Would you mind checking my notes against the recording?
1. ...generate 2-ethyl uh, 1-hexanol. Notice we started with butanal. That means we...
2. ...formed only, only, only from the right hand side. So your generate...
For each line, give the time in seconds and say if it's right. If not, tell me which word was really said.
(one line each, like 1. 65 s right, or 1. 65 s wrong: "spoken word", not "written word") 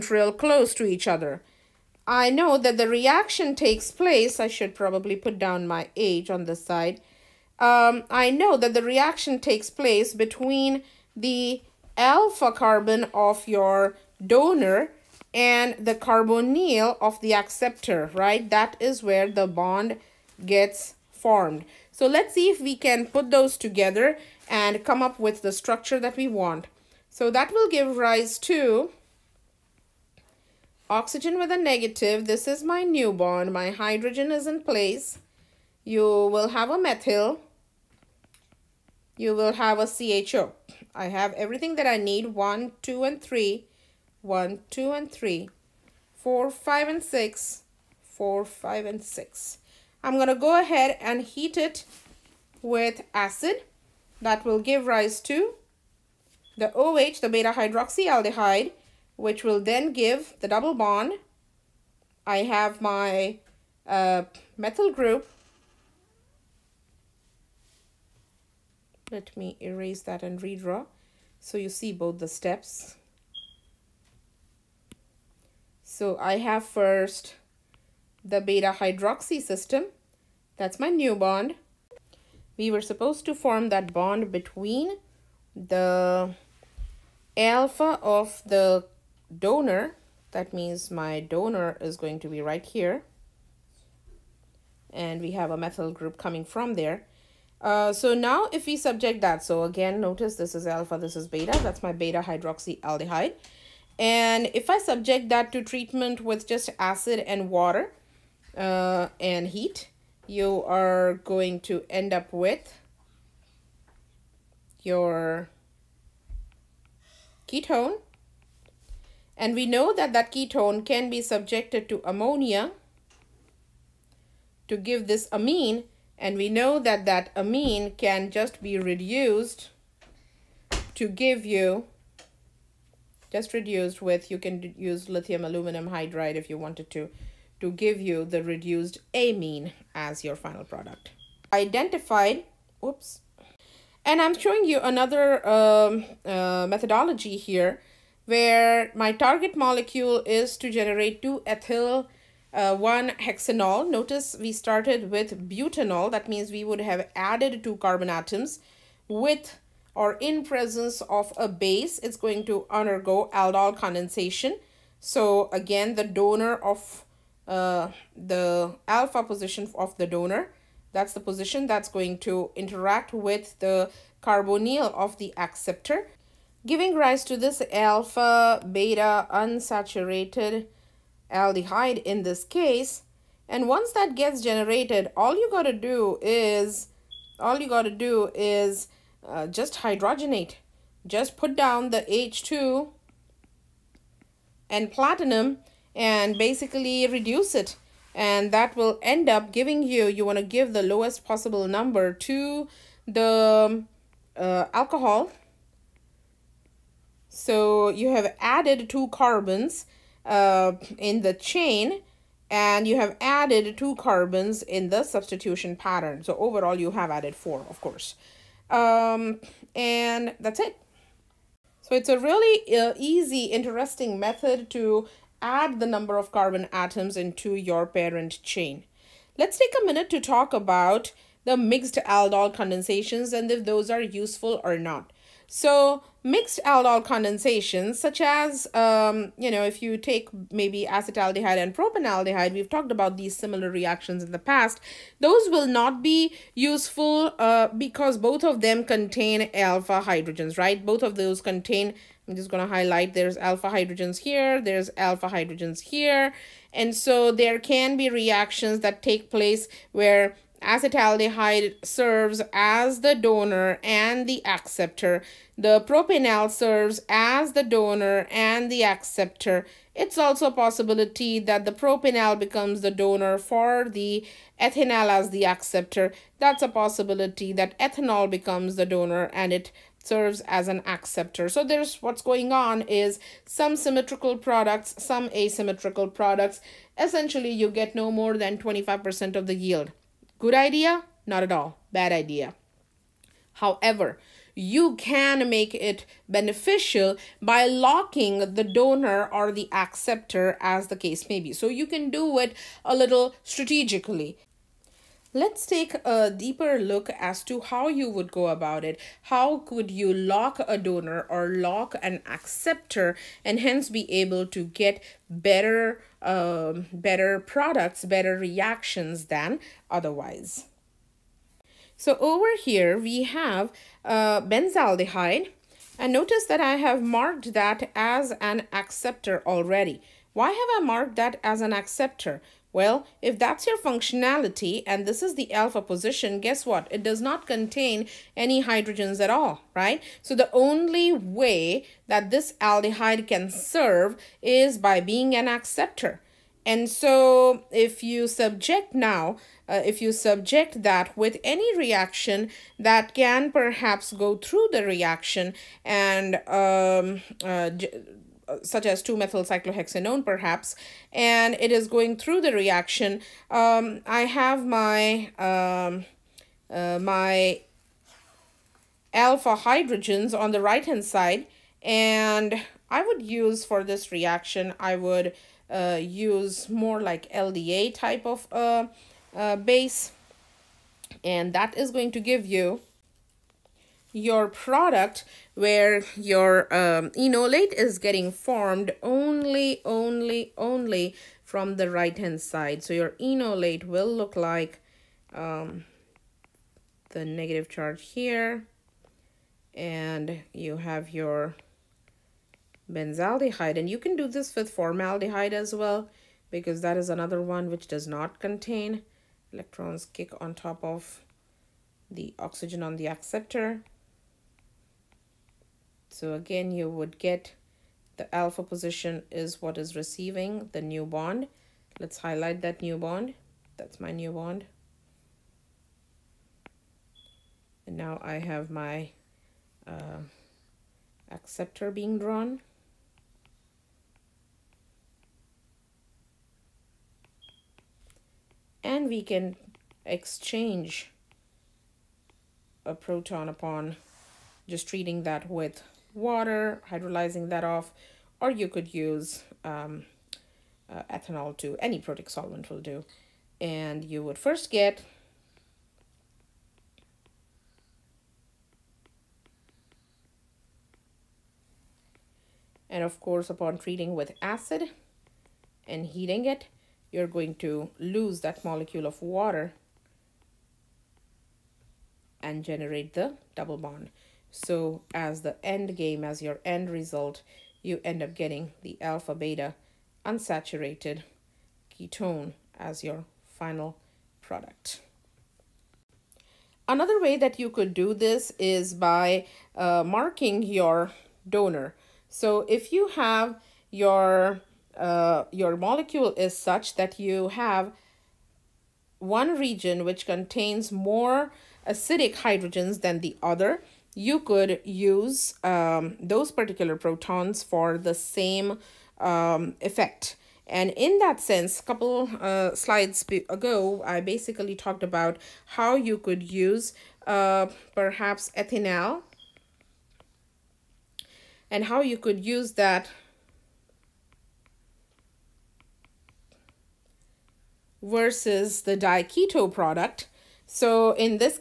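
1. 150 s right
2. 388 s wrong: "enolate", not "generate".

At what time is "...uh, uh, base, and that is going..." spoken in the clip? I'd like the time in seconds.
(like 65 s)
378 s.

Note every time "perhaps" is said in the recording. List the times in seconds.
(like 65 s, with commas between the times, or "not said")
353 s, 360 s, 517 s.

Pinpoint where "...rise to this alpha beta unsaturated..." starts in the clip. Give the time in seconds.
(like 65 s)
176 s.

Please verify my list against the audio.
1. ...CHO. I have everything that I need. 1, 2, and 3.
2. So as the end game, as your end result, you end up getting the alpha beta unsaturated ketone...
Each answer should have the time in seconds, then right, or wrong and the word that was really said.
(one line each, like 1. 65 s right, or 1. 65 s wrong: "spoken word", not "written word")
1. 40 s right
2. 474 s right.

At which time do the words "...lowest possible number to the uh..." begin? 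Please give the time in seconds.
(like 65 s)
200 s.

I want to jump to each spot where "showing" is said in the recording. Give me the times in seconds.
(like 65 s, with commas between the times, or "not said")
144 s.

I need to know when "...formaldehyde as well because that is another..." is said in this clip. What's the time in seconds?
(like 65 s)
404 s.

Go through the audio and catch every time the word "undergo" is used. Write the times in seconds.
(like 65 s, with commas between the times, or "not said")
162 s.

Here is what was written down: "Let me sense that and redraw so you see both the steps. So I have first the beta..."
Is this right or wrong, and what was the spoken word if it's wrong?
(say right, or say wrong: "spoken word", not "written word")
wrong: "erase", not "sense".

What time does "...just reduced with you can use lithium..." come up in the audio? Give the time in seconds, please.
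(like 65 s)
133 s.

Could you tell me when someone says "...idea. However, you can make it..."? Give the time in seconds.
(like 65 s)
292 s.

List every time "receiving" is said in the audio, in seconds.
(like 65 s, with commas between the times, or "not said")
419 s.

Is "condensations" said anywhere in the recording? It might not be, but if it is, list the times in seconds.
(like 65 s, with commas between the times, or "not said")
163 s, 232 s, 237 s.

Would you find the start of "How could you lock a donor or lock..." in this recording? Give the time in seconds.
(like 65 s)
309 s.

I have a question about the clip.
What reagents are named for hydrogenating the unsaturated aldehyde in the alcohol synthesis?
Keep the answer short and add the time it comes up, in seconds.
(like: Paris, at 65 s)
H2 and platinum, at 192 s.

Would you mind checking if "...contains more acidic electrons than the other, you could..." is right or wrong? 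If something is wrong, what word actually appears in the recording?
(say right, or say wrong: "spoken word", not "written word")
wrong: "hydrogens", not "electrons".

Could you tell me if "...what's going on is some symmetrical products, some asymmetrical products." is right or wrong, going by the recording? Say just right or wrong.
right.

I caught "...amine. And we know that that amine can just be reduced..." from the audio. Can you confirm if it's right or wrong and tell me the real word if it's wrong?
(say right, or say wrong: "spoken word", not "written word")
right.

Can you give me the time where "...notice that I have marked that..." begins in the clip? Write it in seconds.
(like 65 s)
326 s.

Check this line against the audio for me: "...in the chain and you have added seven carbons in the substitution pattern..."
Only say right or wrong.
wrong.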